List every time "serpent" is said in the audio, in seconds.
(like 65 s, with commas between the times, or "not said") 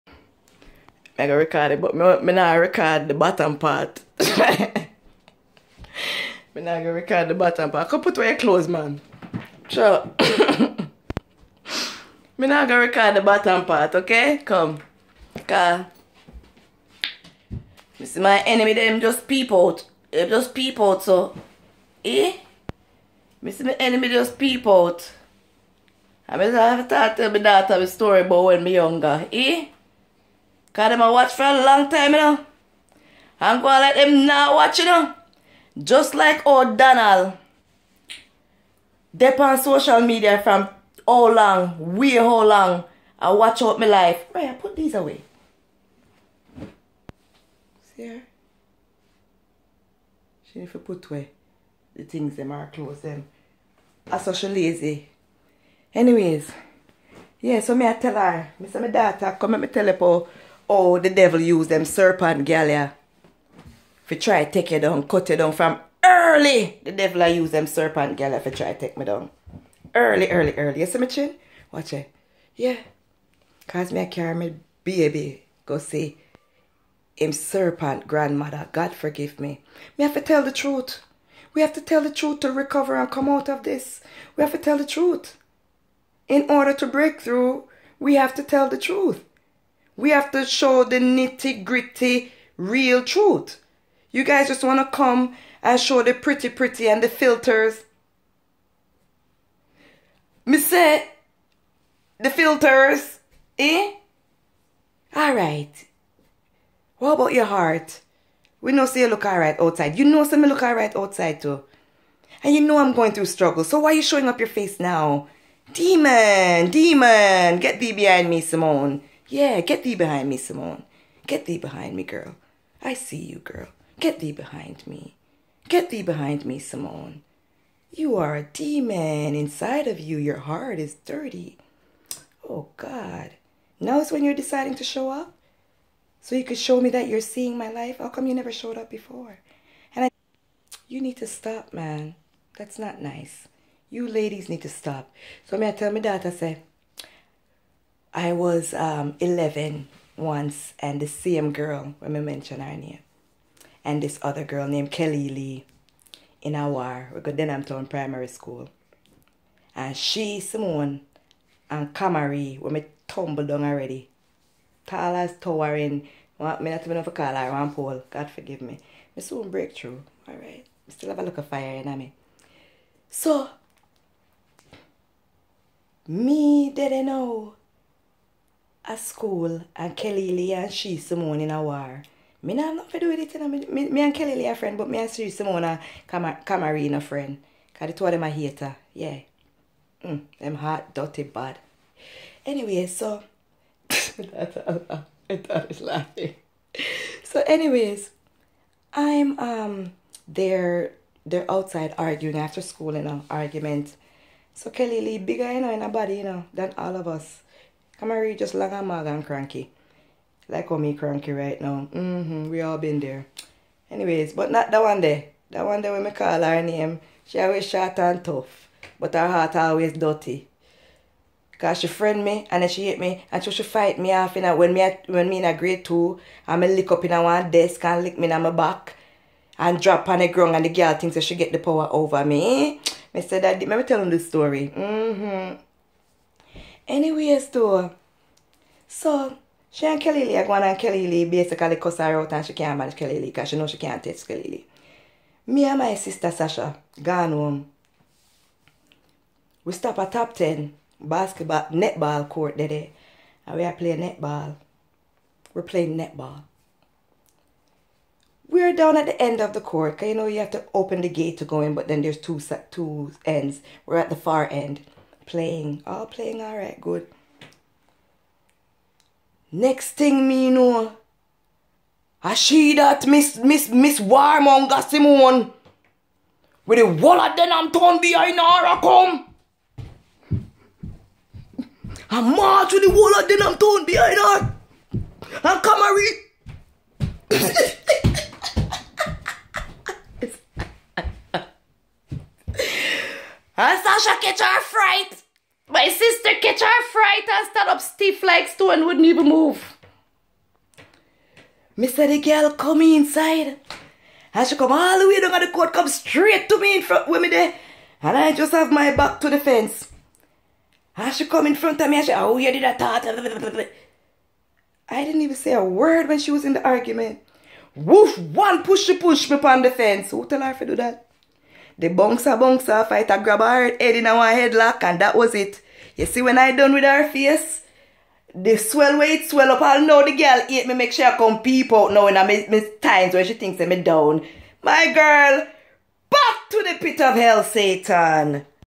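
61 s, 67 s, 77 s.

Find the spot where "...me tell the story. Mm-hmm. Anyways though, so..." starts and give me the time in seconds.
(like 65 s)
233 s.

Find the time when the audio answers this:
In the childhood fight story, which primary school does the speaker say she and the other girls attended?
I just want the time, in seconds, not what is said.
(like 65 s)
157 s.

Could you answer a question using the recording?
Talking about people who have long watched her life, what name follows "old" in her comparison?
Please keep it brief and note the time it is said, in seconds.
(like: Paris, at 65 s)
Donald, at 36 s.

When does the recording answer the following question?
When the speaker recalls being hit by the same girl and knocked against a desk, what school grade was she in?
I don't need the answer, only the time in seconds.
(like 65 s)
225 s.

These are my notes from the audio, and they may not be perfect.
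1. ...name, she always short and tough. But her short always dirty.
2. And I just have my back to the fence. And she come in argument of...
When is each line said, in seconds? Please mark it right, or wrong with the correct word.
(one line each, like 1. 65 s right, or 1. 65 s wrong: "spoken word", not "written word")
1. 216 s wrong: "heart", not "short"
2. 308 s wrong: "front", not "argument".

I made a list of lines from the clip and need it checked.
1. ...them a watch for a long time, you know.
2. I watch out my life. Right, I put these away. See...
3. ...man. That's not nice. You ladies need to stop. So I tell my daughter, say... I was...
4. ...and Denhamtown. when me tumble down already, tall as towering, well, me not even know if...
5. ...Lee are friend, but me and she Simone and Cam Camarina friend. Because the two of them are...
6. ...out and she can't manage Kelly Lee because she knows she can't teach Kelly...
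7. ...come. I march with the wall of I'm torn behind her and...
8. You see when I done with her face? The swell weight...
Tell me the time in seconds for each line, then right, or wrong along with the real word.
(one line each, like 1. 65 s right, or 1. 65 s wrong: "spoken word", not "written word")
1. 30 s right
2. 43 s right
3. 141 s right
4. 161 s wrong: "Camarie", not "Denhamtown"
5. 184 s right
6. 242 s right
7. 278 s right
8. 325 s right.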